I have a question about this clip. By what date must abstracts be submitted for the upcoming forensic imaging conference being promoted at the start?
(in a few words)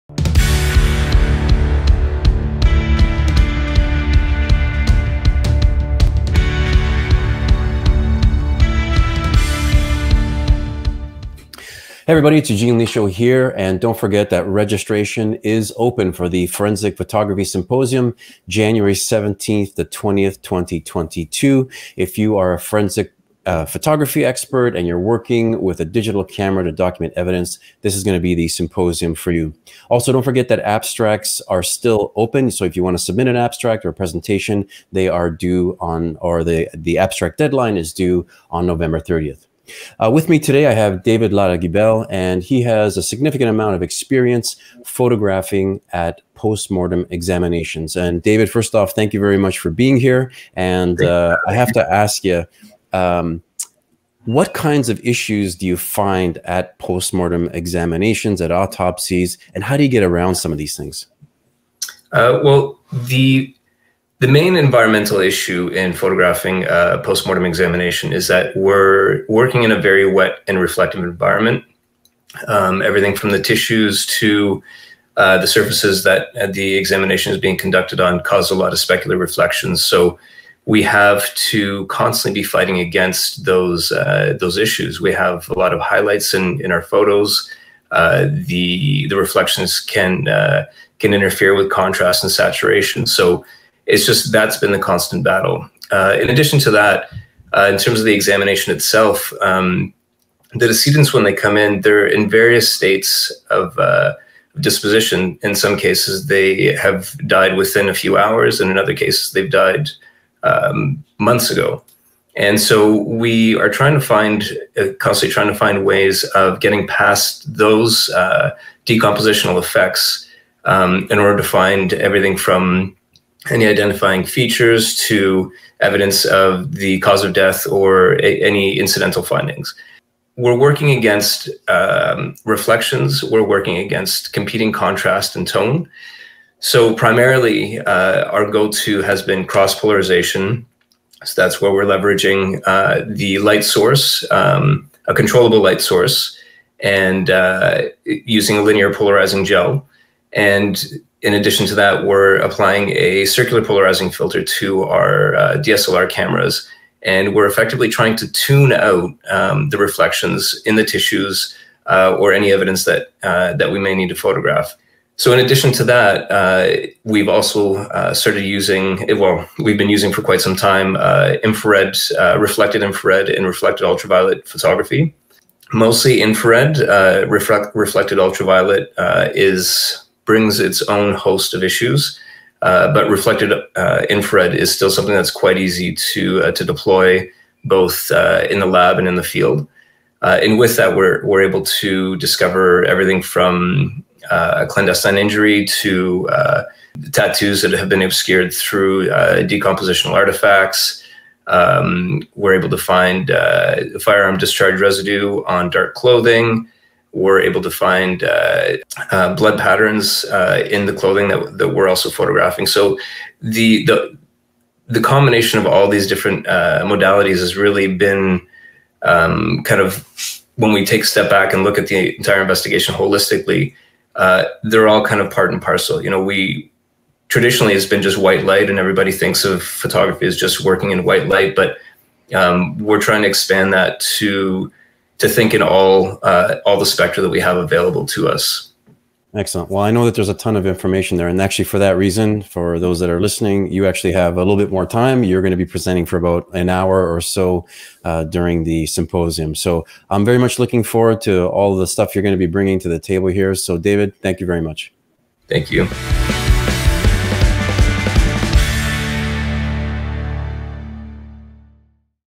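November 30th.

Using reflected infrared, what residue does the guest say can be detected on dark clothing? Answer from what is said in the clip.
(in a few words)
Firearm discharge residue.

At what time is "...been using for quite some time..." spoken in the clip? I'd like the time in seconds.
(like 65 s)
169 s.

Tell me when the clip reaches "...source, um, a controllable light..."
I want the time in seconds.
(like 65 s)
143 s.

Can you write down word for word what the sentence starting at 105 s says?
In some cases, they have died within a few hours, and in other cases, they've died um, months ago.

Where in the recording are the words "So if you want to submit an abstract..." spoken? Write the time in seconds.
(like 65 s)
32 s.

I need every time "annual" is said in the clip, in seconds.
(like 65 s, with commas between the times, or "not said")
not said.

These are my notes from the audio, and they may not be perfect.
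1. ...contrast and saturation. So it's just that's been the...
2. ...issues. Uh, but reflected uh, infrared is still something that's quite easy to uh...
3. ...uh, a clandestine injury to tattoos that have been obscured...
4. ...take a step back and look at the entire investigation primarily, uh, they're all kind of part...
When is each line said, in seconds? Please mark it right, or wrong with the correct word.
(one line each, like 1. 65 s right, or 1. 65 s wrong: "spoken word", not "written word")
1. 91 s right
2. 181 s right
3. 194 s right
4. 220 s wrong: "holistically", not "primarily".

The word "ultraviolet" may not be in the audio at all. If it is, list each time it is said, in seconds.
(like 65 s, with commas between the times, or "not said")
173 s, 178 s.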